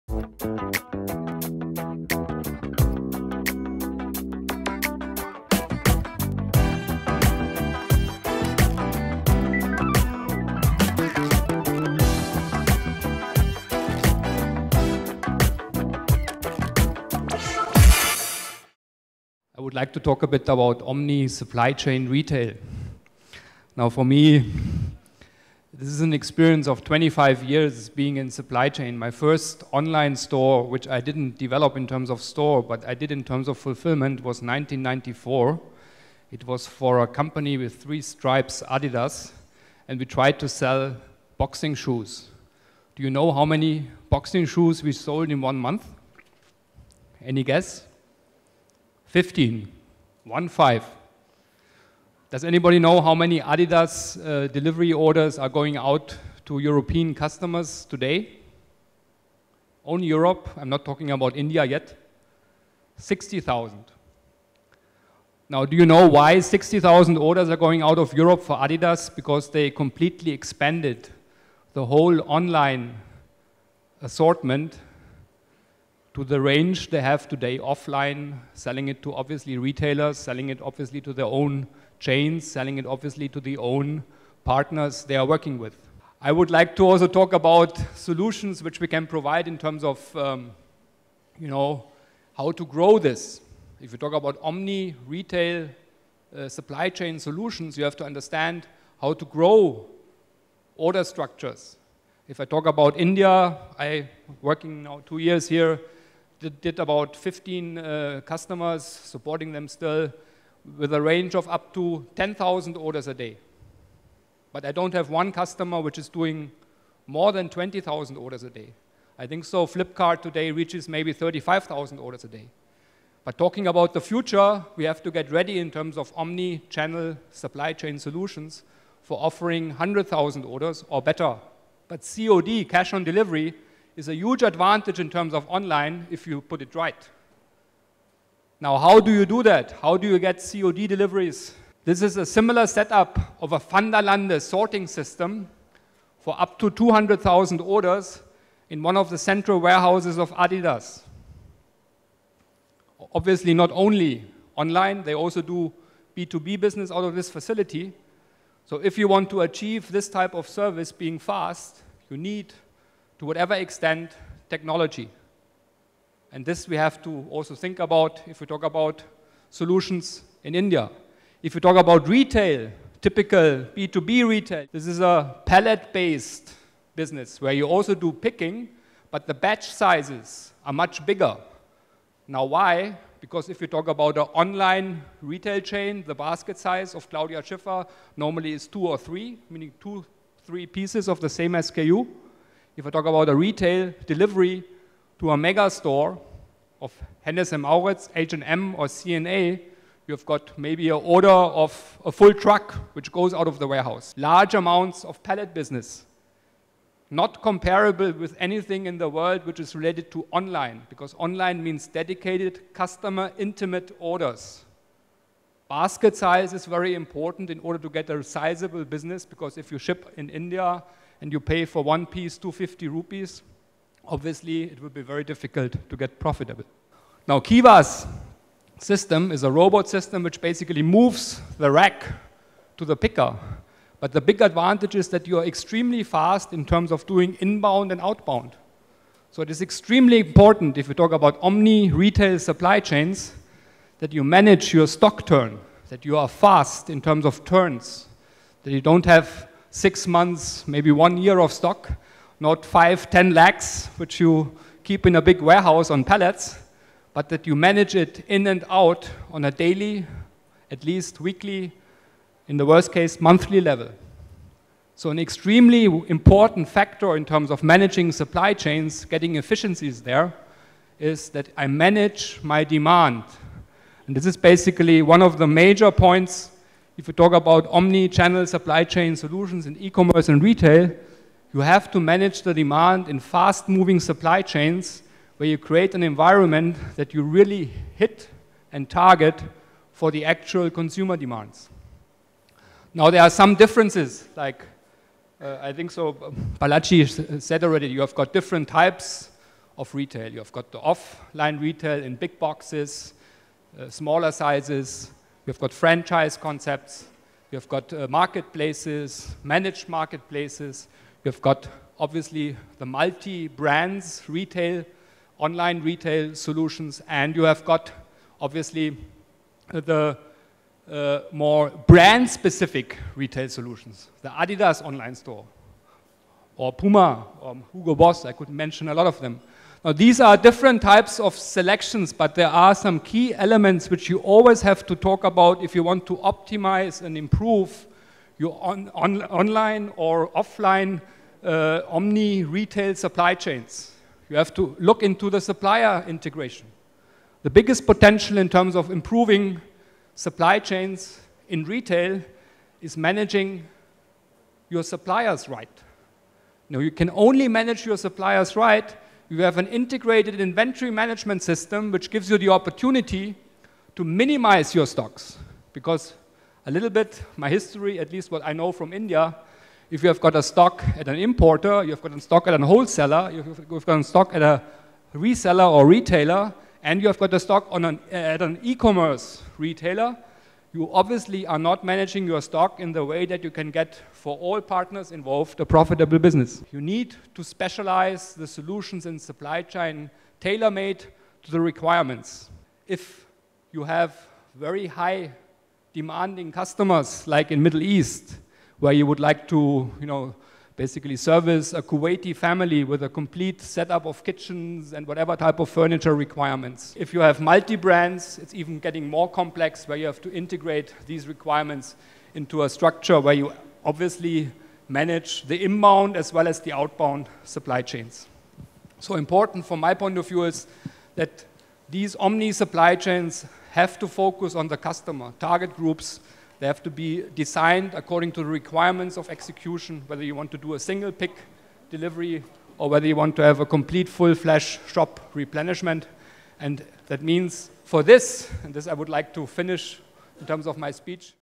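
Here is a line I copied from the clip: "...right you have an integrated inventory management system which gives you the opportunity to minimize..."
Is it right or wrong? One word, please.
right.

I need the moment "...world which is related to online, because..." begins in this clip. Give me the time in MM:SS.
03:29.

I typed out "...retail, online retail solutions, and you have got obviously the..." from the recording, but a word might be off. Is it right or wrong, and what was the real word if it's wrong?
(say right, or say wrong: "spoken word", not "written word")
right.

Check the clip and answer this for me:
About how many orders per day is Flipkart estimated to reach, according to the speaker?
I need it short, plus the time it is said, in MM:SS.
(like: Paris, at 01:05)
35,000, at 02:01.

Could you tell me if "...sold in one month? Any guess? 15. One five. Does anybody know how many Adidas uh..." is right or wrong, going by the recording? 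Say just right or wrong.
right.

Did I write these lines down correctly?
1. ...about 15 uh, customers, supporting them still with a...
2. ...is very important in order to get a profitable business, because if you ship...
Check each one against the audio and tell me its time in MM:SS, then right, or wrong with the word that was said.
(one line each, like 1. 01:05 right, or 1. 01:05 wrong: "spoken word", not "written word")
1. 01:46 right
2. 03:36 wrong: "sizable", not "profitable".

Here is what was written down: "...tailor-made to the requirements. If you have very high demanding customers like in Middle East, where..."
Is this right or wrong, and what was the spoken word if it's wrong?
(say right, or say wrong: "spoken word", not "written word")
right.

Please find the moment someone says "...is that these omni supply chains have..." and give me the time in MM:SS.
07:00.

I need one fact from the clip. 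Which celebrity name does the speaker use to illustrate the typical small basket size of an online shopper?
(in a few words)
Claudia Schiffer.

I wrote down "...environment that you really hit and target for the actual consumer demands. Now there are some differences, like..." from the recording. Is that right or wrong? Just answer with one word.
right.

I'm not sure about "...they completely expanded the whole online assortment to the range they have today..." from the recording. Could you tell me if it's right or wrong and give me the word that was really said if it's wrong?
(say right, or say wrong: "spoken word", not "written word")
right.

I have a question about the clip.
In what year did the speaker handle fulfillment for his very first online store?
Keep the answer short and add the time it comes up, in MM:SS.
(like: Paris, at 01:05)
1994, at 00:34.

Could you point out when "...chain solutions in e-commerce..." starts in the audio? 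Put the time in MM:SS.
04:38.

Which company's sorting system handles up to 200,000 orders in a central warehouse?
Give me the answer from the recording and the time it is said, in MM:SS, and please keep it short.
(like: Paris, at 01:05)
Vanderlande, at 02:23.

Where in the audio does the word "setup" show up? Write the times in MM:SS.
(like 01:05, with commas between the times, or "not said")
02:22, 06:43.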